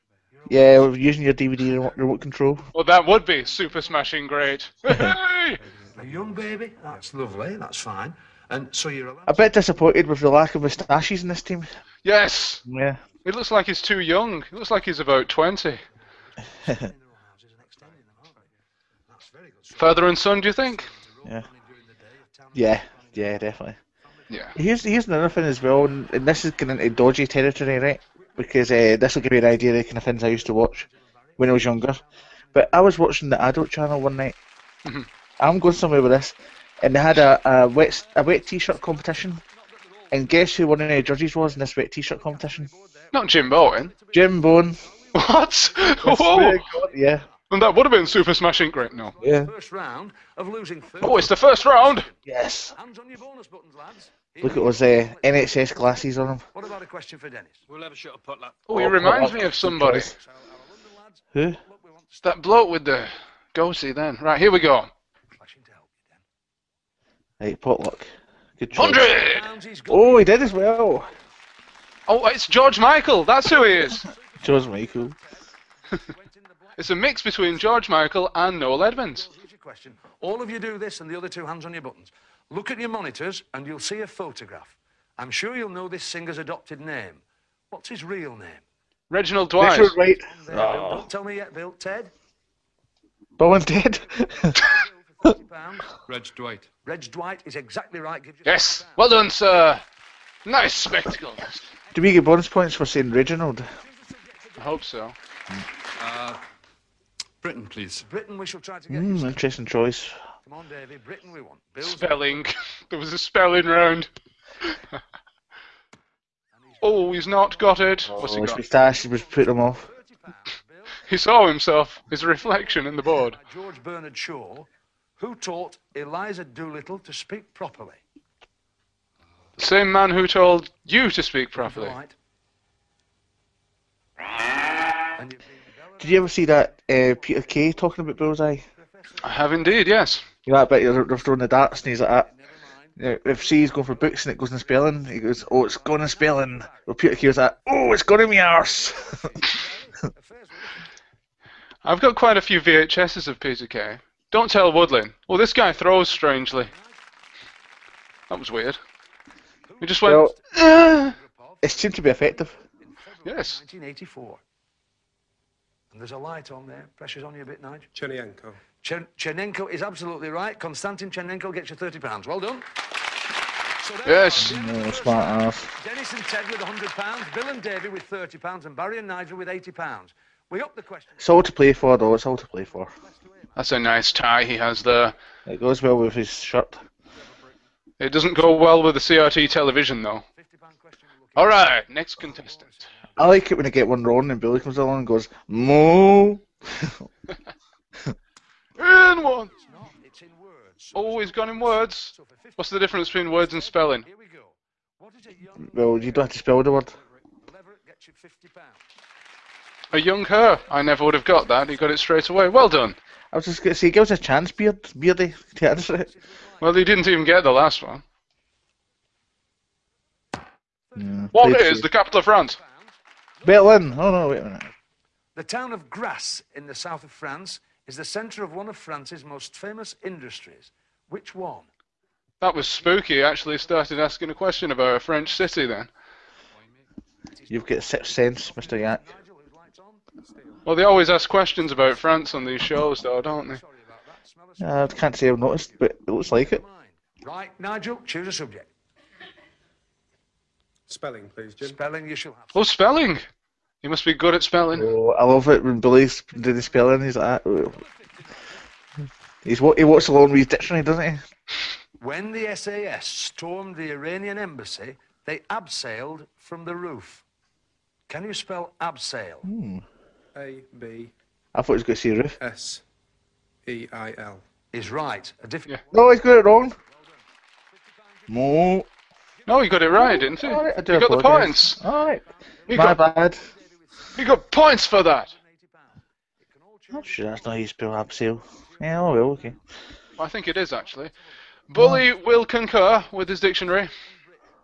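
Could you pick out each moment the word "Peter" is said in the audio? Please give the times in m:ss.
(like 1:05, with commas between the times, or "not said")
2:17, 2:26, 2:33.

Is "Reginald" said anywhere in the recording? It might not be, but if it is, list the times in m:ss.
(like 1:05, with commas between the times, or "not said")
1:29, 1:43.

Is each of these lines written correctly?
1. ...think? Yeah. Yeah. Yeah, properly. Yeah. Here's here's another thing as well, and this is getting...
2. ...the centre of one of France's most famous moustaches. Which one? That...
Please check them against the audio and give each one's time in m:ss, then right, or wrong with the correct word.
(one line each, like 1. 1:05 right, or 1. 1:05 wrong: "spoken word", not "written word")
1. 0:20 wrong: "definitely", not "properly"
2. 3:47 wrong: "industries", not "moustaches".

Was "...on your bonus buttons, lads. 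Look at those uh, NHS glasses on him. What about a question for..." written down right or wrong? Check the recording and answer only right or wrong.
right.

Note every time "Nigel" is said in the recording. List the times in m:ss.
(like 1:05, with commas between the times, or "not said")
2:47, 2:59, 4:07.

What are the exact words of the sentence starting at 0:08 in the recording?
And so you're a bit disappointed with the lack of moustaches in this team.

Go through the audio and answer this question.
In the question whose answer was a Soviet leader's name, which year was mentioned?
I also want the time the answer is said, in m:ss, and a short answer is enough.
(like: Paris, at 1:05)
1984, at 2:43.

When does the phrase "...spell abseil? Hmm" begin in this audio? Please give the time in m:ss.
4:28.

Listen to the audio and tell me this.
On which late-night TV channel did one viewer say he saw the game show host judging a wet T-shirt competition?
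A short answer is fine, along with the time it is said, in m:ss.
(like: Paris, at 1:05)
the Adult Channel, at 0:33.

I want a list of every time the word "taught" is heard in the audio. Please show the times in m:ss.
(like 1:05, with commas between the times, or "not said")
2:05.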